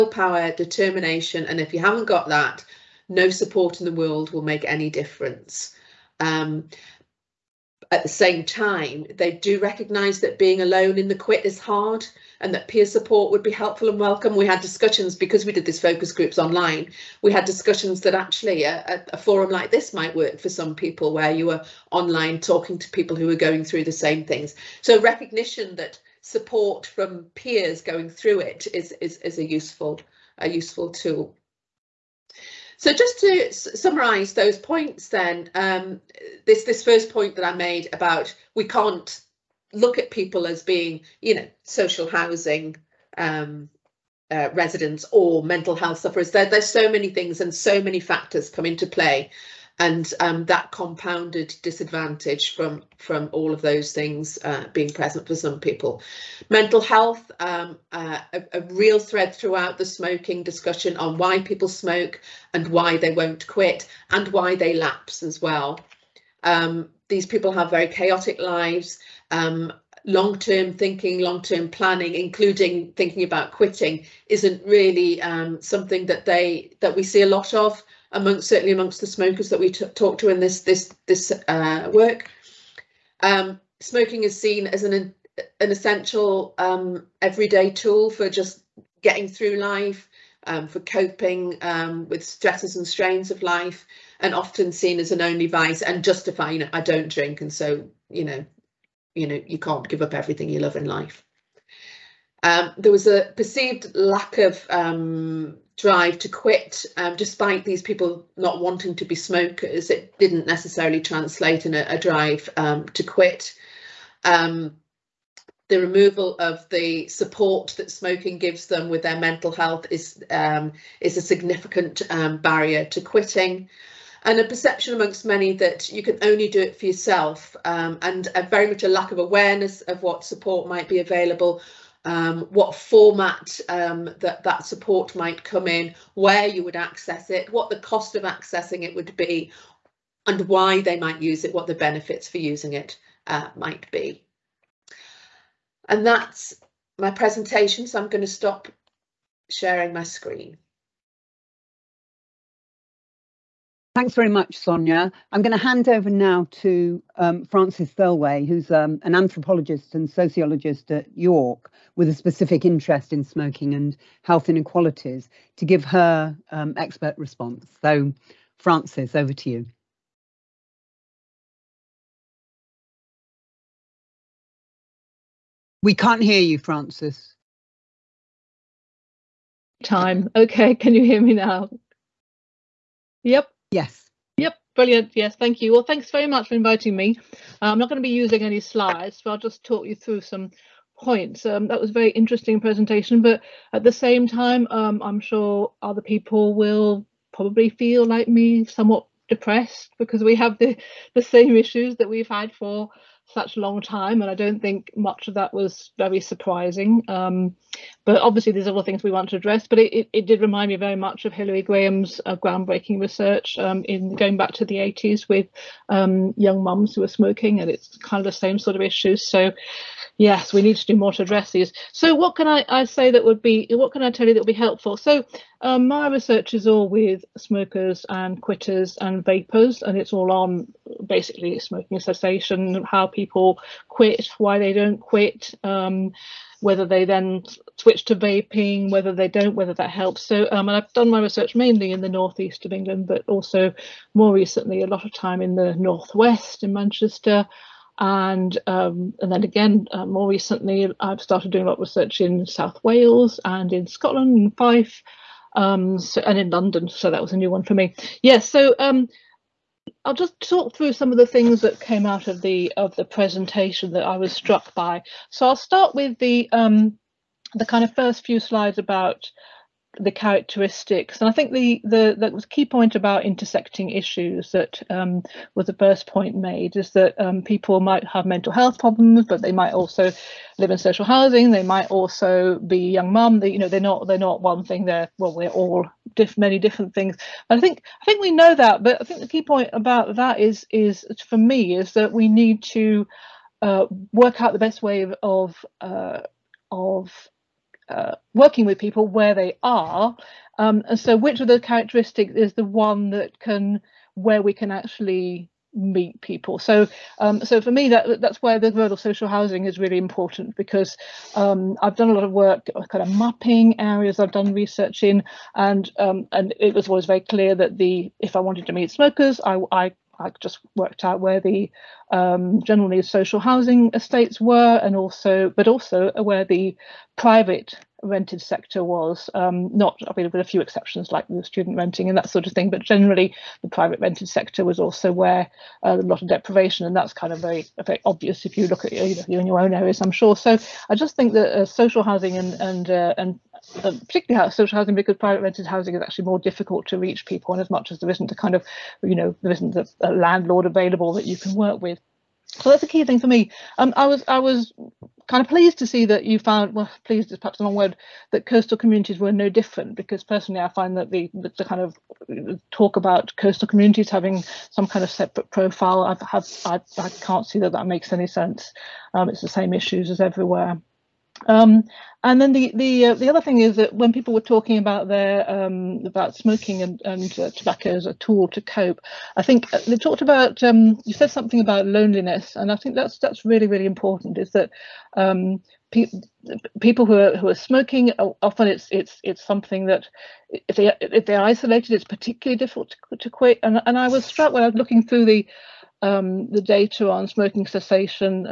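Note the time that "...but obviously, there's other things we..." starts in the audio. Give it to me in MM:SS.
03:28.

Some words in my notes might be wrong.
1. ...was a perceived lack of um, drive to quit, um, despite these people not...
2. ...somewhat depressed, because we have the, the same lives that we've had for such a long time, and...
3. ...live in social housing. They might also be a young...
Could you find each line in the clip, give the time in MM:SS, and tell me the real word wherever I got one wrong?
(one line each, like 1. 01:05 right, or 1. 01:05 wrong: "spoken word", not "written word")
1. 01:42 right
2. 03:18 wrong: "issues", not "lives"
3. 04:40 right.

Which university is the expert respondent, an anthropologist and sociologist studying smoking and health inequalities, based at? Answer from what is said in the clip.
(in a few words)
York.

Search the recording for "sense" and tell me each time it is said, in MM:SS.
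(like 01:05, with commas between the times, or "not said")
06:08.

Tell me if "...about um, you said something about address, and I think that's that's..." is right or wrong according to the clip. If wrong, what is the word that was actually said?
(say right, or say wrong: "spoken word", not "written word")
wrong: "loneliness", not "address".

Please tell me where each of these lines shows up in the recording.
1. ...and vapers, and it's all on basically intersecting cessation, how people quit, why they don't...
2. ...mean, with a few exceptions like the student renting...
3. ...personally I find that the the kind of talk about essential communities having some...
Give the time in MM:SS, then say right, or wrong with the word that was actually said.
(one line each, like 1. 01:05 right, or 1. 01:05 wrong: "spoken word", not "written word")
1. 03:48 wrong: "smoking", not "intersecting"
2. 05:30 right
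3. 06:00 wrong: "coastal", not "essential".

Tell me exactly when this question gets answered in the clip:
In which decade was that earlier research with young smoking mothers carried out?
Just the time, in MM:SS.
03:34.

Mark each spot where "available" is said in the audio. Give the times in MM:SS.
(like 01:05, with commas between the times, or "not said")
02:10, 05:50.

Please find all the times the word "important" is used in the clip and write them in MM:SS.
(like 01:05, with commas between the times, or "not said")
05:09, 06:23.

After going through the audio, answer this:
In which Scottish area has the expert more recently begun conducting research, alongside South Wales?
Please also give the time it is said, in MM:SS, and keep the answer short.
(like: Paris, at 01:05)
Fife, at 04:14.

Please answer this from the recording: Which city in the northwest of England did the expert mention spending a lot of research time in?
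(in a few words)
Manchester.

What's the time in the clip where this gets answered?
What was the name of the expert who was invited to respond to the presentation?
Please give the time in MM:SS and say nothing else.
02:37.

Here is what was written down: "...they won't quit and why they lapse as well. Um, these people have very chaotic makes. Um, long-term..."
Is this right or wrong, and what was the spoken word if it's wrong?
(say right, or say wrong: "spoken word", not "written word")
wrong: "lives", not "makes".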